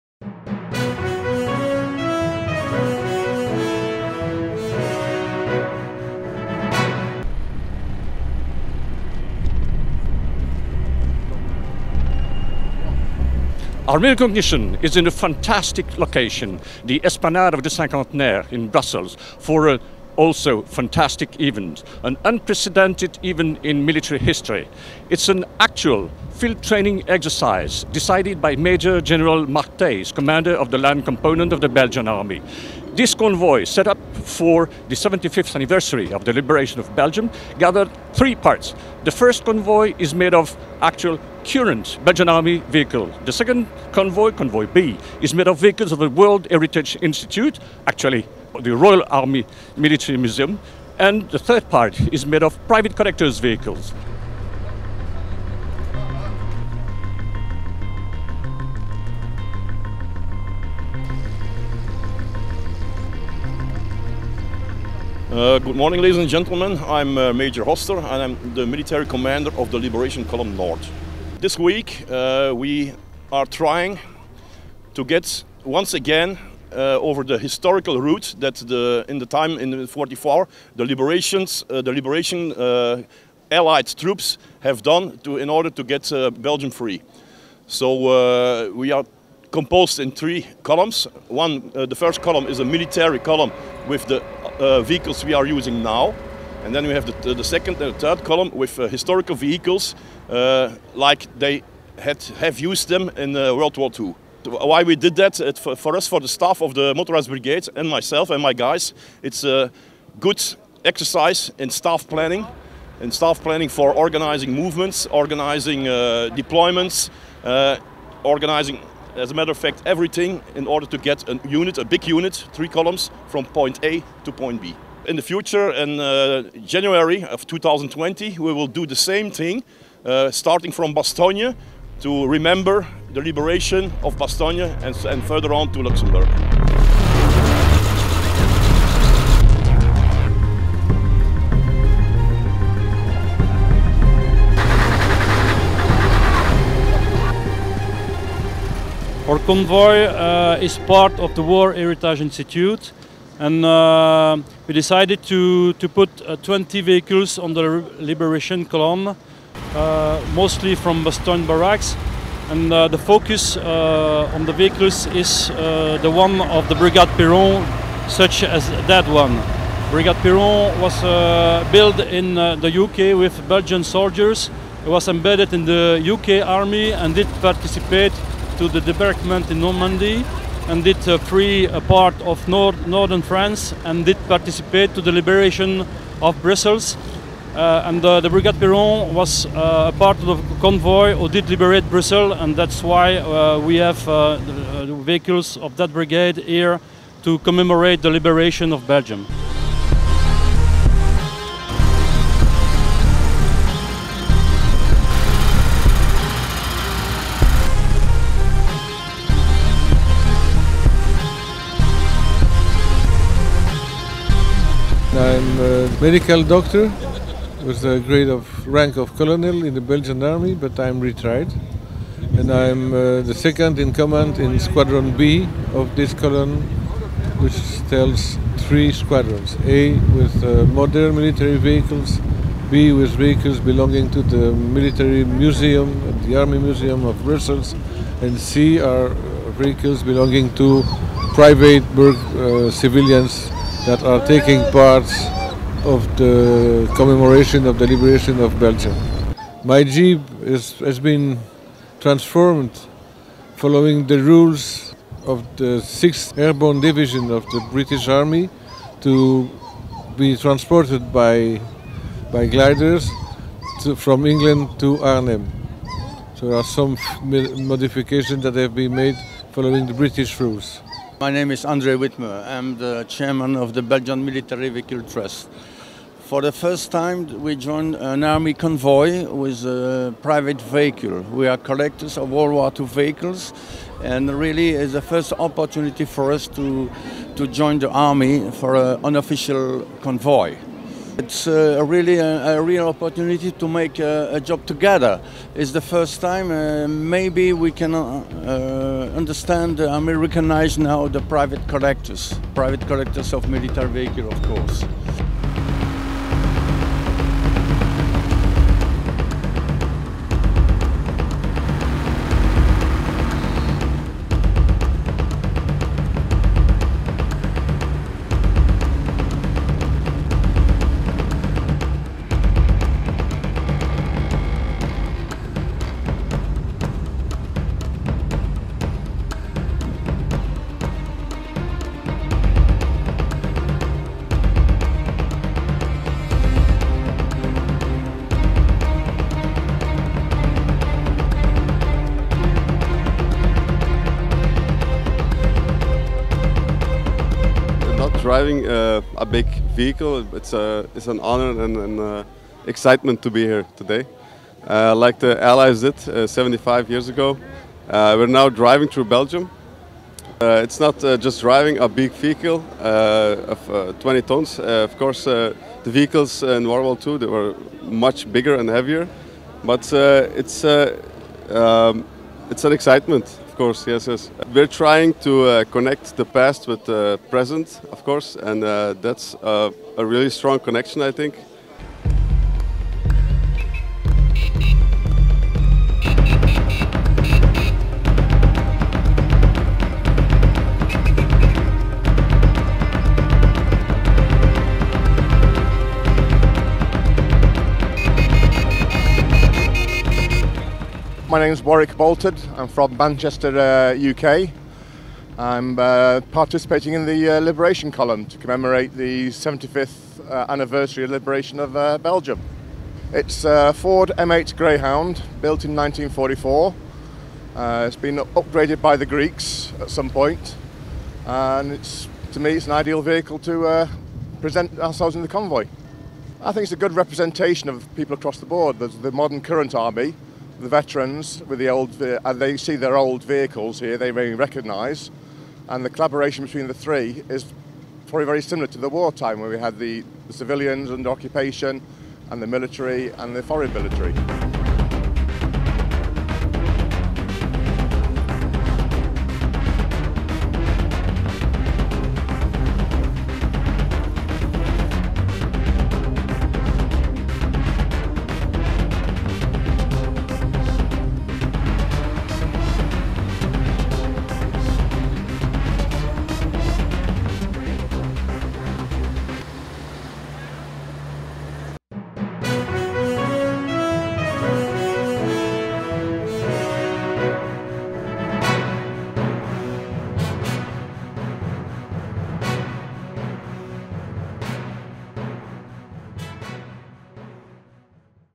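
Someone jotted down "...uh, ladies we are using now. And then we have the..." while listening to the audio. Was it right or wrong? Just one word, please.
wrong.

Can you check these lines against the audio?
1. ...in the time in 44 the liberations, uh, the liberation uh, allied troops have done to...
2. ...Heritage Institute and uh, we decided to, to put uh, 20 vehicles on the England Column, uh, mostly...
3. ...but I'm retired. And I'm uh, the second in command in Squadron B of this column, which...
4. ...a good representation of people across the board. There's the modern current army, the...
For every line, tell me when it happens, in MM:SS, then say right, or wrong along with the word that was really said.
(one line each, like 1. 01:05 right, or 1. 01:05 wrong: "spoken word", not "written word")
1. 01:19 right
2. 02:31 wrong: "Liberation", not "England"
3. 03:40 right
4. 07:06 right.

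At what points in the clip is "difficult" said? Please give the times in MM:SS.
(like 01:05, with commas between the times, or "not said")
not said.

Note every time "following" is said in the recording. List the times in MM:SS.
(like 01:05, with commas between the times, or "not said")
04:13, 04:29.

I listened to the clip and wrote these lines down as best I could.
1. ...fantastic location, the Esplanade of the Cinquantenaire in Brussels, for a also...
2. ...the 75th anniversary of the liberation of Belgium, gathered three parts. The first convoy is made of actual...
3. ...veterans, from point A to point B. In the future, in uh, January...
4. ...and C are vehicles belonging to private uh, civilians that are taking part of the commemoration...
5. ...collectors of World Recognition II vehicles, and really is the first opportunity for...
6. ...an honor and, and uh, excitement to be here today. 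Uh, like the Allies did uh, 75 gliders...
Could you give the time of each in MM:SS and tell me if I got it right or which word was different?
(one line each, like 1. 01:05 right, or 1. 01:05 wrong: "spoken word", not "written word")
1. 00:15 right
2. 00:34 right
3. 02:02 wrong: "columns", not "veterans"
4. 03:58 right
5. 04:41 wrong: "War", not "Recognition"
6. 05:51 wrong: "years", not "gliders".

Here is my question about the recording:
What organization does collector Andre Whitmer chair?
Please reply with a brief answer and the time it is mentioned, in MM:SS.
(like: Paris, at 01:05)
Belgian Military Vehicle Trust, at 04:33.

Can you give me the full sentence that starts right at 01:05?
Uh, good morning, ladies and gentlemen.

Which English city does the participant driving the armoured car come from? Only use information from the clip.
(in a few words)
Manchester.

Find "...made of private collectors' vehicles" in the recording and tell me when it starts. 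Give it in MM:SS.
00:52.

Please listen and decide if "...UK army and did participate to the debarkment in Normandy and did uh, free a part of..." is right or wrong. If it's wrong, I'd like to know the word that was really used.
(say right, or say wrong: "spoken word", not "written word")
right.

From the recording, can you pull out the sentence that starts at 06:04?
of course, the vehicles in World War II they were much bigger and heavier, but it's, um, it's an excitement.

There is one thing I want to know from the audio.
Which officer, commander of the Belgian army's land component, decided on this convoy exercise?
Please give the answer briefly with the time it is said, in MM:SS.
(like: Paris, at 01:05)
Marc Thys, at 00:29.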